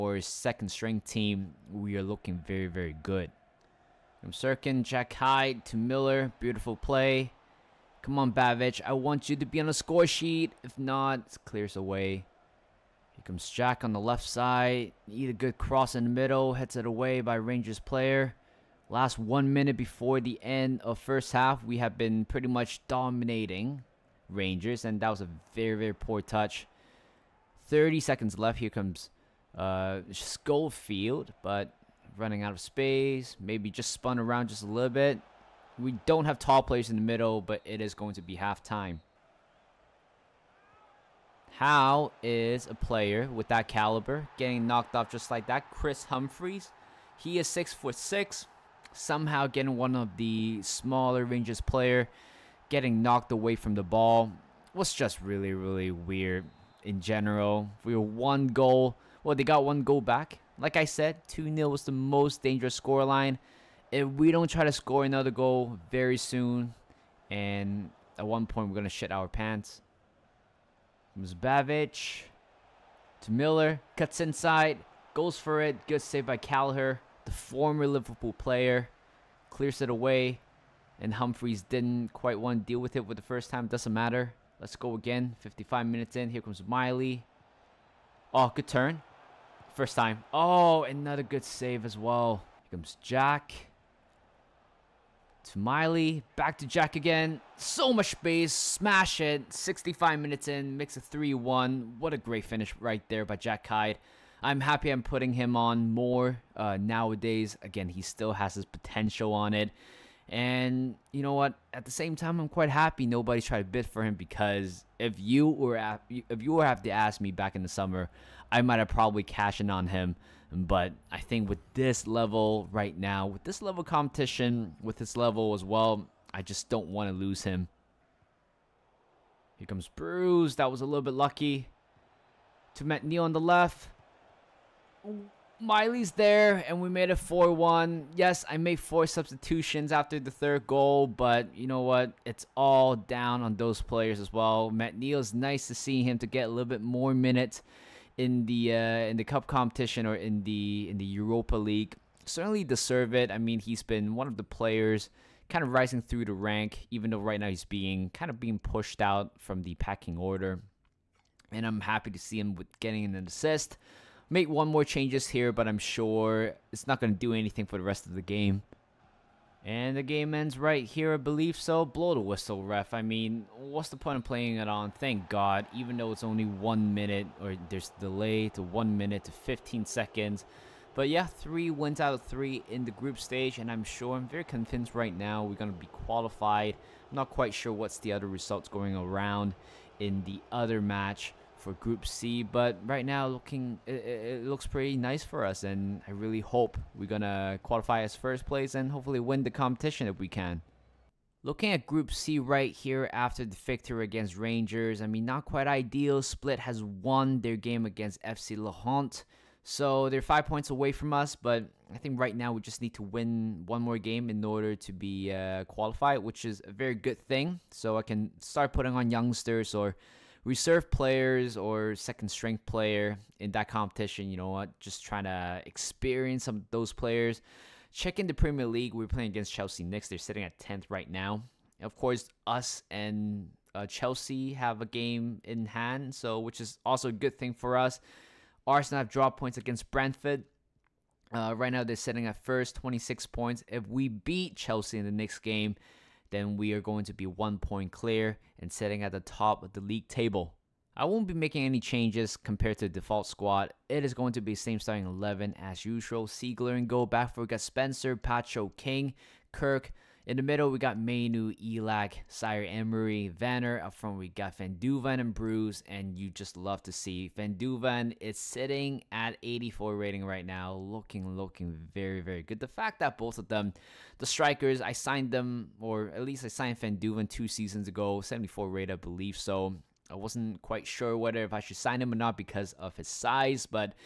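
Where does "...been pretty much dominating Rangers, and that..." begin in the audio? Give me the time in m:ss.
0:21.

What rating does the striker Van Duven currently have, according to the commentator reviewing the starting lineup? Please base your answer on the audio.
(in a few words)
84.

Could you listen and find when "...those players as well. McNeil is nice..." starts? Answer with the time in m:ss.
2:23.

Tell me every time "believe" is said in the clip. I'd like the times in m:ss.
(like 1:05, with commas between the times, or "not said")
2:51, 4:38.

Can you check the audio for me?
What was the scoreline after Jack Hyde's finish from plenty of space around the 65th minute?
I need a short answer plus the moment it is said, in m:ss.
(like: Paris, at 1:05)
3-1, at 1:40.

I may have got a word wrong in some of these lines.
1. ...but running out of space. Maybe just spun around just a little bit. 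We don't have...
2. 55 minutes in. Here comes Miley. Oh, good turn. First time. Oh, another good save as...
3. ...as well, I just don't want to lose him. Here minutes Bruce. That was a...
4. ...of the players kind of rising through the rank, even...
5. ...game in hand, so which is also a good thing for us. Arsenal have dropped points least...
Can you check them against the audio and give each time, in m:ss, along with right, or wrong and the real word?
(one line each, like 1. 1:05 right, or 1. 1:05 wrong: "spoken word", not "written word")
1. 0:31 right
2. 1:25 right
3. 2:05 wrong: "comes", not "minutes"
4. 2:34 right
5. 3:54 wrong: "against", not "least".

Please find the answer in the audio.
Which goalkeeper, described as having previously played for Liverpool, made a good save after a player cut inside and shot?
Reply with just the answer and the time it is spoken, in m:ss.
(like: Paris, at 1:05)
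Callagher, at 1:16.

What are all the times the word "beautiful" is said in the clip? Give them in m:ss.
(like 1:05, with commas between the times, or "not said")
0:06.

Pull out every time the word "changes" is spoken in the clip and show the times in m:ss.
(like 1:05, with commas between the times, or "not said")
2:44, 4:11.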